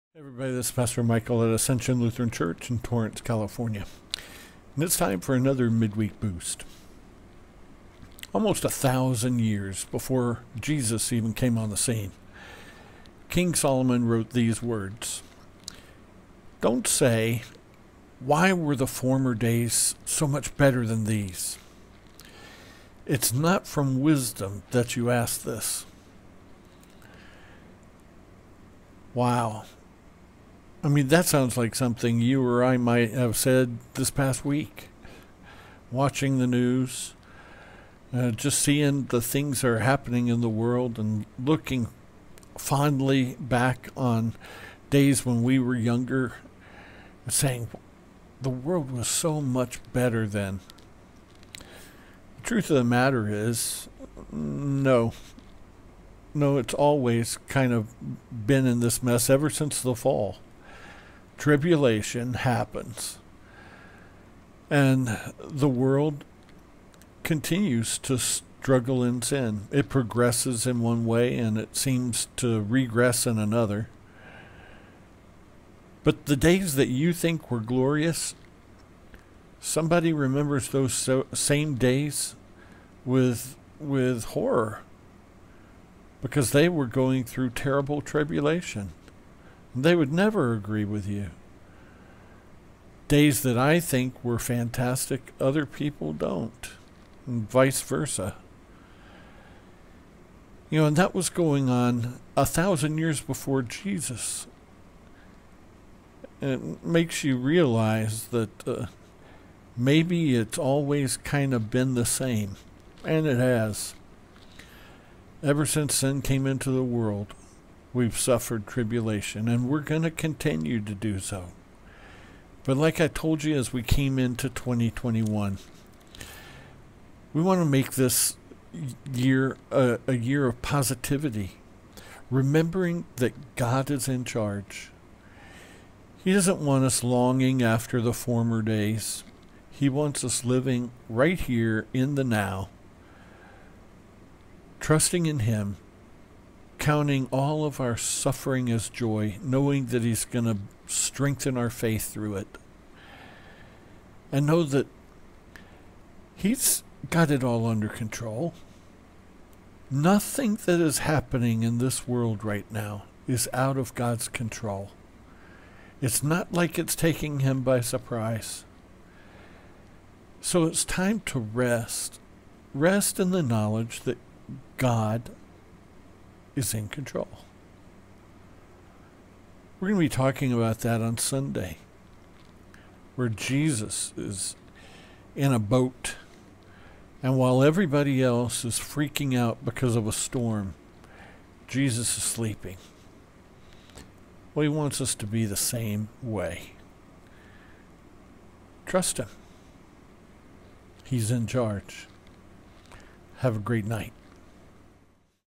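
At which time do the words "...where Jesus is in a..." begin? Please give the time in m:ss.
3:03.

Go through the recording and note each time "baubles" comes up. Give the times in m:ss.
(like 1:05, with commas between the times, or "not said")
not said.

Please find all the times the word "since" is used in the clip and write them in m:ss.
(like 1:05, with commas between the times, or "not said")
0:59, 1:55.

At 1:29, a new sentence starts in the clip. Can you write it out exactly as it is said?
They would never agree with you.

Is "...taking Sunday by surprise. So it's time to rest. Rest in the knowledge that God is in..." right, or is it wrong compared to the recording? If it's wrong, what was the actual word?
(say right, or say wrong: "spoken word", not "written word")
wrong: "Him", not "Sunday".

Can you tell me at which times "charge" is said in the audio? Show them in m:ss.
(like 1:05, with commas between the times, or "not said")
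2:14, 3:21.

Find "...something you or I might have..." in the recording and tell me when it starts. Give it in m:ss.
0:31.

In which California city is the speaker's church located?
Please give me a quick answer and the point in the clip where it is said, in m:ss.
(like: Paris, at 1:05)
Torrance, at 0:02.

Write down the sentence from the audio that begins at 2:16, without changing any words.
He doesn't want us longing after the former days.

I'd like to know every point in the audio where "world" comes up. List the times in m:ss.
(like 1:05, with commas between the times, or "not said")
0:40, 0:48, 1:05, 1:56, 2:42.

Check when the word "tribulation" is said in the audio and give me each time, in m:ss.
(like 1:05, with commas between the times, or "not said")
1:01, 1:27, 1:58.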